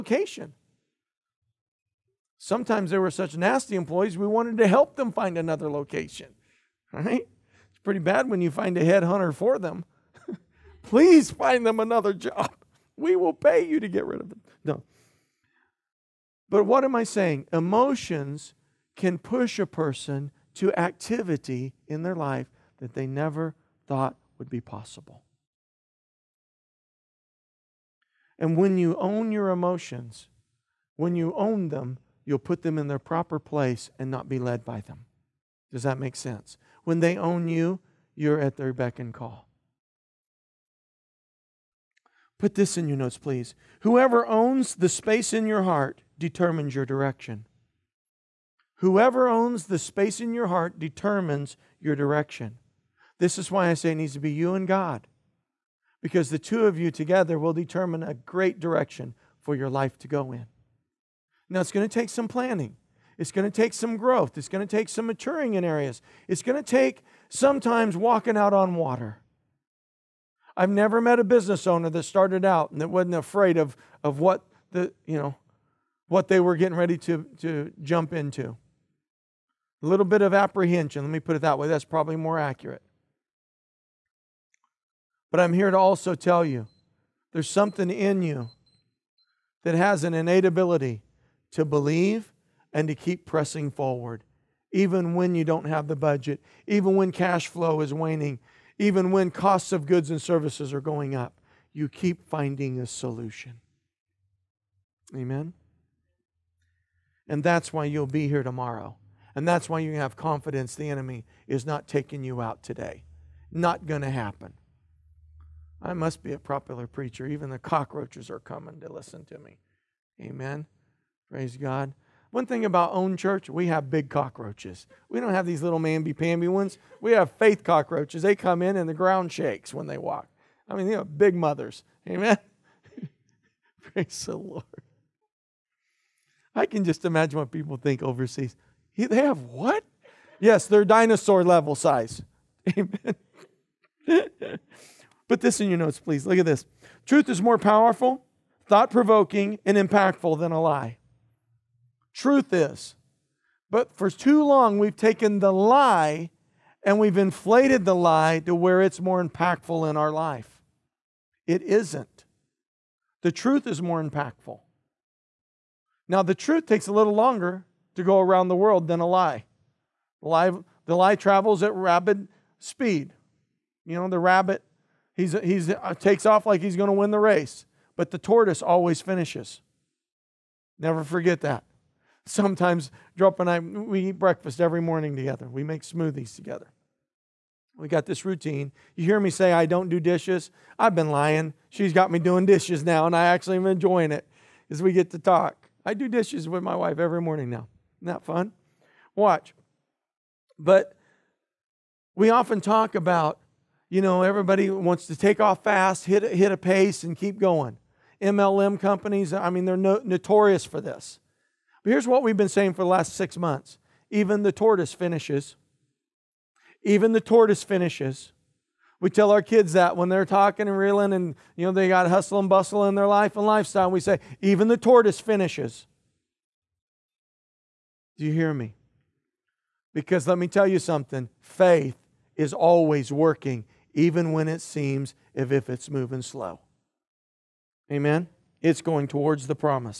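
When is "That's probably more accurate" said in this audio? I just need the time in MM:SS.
01:21.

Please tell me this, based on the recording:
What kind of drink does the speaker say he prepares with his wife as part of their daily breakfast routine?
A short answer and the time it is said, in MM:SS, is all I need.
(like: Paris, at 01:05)
smoothies, at 03:05.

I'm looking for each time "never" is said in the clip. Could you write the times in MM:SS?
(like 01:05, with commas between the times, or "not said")
00:23, 01:10, 03:00.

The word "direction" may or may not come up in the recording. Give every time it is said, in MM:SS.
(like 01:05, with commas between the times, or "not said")
00:46, 00:51, 00:58.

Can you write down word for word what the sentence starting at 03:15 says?
I do dishes with my wife every morning now.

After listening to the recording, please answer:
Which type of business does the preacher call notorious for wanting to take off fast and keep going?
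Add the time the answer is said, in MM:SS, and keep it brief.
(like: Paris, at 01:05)
MLM companies, at 03:28.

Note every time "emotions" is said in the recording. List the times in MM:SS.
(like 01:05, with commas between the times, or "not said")
00:17, 00:29.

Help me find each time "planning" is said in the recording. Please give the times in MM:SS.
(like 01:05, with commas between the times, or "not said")
01:02.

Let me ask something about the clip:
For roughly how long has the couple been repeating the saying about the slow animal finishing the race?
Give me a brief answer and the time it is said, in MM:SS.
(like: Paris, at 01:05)
6 months, at 03:33.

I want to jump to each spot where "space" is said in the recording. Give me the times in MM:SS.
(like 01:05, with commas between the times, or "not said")
00:44, 00:49.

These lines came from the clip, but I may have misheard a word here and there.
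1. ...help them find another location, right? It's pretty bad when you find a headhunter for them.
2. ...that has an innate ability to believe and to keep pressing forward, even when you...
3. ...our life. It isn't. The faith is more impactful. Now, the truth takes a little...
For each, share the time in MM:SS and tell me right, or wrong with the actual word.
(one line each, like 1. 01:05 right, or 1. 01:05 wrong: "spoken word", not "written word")
1. 00:04 right
2. 01:29 right
3. 02:39 wrong: "truth", not "faith".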